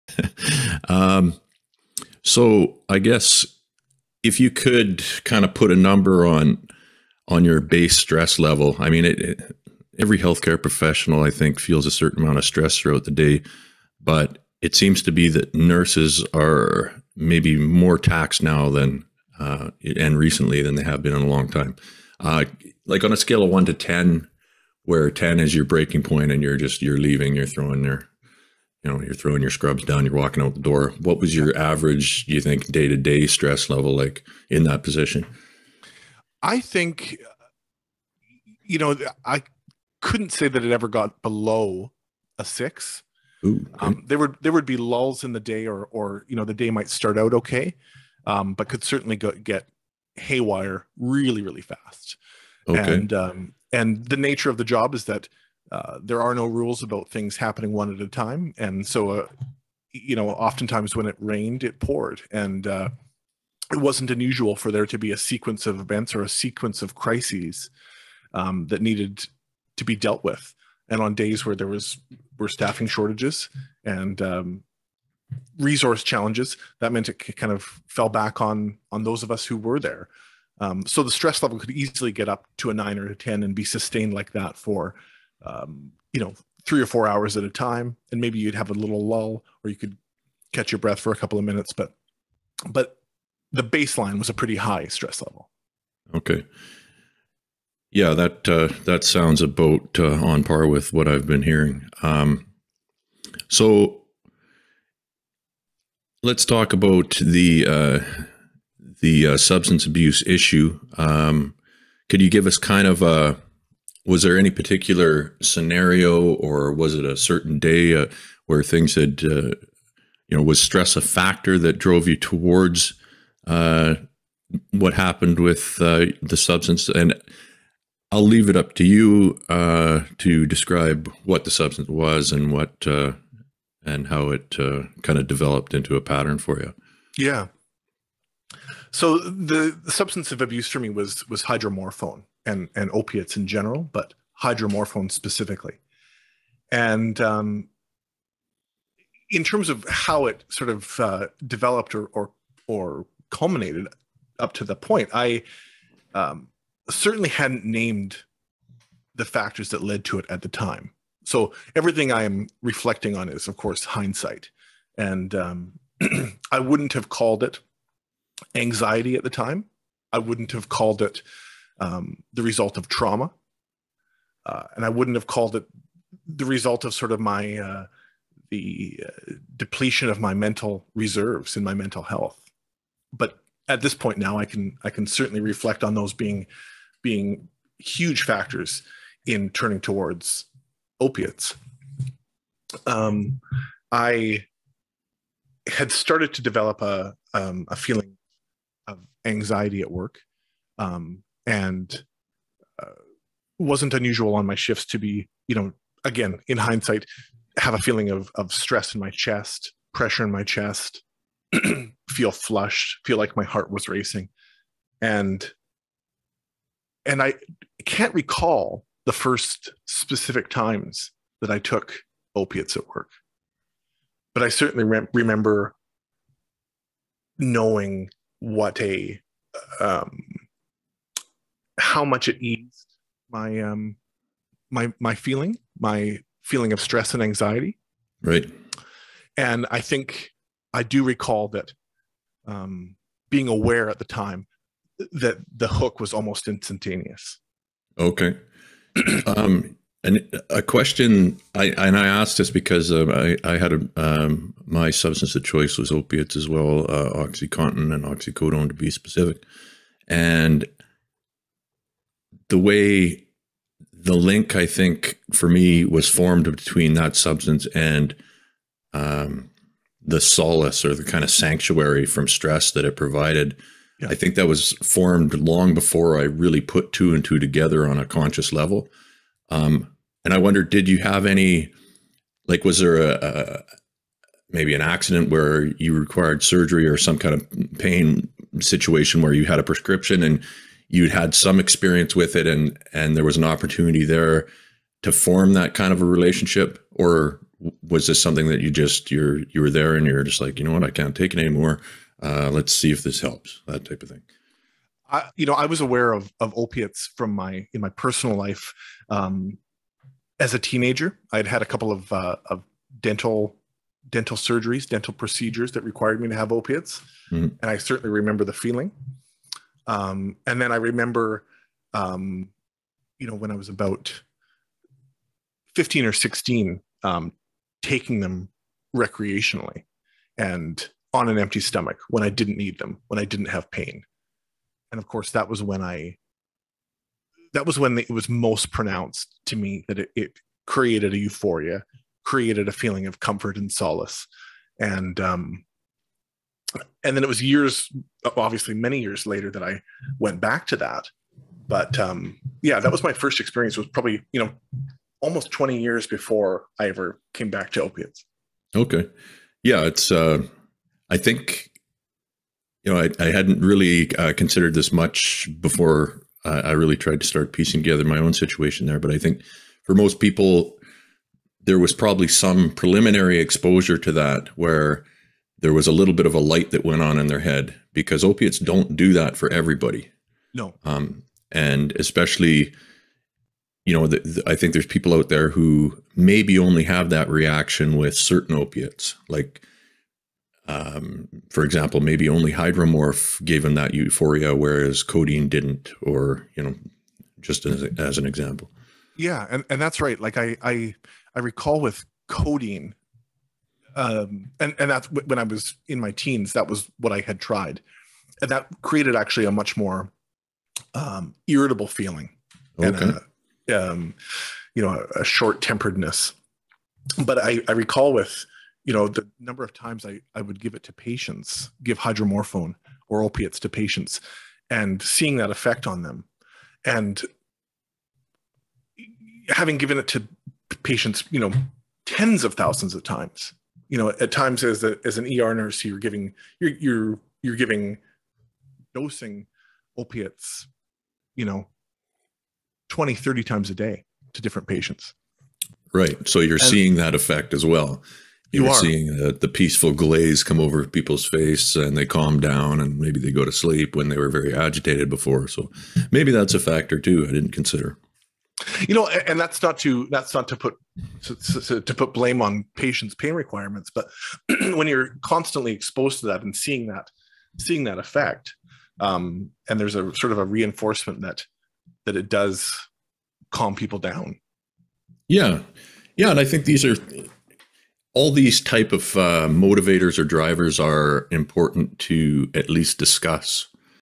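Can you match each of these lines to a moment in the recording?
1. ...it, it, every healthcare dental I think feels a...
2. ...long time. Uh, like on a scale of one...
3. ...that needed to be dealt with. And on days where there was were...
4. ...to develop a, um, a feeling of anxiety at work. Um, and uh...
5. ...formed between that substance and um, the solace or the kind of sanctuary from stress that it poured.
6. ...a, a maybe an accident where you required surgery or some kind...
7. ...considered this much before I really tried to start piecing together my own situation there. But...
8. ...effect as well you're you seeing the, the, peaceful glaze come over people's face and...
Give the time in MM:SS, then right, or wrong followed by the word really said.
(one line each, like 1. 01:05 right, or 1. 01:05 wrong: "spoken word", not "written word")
1. 00:09 wrong: "professional", not "dental"
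2. 00:21 right
3. 01:08 right
4. 03:16 right
5. 04:26 wrong: "provided", not "poured"
6. 04:42 right
7. 06:04 right
8. 07:27 right.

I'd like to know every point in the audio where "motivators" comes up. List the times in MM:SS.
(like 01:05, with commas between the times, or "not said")
07:59.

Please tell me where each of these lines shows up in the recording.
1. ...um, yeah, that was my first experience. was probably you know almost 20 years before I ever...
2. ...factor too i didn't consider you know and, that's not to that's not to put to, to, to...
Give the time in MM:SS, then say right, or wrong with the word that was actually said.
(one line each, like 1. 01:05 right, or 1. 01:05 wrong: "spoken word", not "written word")
1. 05:51 right
2. 07:36 right.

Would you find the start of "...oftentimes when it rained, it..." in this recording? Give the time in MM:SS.
01:00.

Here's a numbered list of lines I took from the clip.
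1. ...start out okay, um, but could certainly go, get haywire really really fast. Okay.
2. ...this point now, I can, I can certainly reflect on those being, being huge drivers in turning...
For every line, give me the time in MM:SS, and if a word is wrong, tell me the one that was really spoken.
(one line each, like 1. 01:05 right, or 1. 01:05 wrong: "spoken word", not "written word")
1. 00:46 right
2. 03:03 wrong: "factors", not "drivers".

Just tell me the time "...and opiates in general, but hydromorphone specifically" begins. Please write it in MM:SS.
02:22.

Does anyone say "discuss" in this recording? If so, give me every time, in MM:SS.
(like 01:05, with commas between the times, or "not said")
08:02.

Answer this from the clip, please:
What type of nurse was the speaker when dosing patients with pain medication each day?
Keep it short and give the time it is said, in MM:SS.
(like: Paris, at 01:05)
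ER nurse, at 07:15.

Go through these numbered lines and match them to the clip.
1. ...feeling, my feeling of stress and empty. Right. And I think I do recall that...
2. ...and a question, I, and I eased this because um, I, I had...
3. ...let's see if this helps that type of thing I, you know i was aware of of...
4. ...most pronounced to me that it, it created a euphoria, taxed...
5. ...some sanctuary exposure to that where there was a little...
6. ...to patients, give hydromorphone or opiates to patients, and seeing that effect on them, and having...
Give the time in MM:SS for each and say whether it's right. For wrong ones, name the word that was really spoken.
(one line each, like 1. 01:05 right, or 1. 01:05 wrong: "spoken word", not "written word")
1. 03:55 wrong: "anxiety", not "empty"
2. 04:10 wrong: "asked", not "eased"
3. 05:02 right
4. 05:38 wrong: "created", not "taxed"
5. 06:12 wrong: "preliminary", not "sanctuary"
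6. 07:00 right.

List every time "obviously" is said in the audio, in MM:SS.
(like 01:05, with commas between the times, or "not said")
05:48.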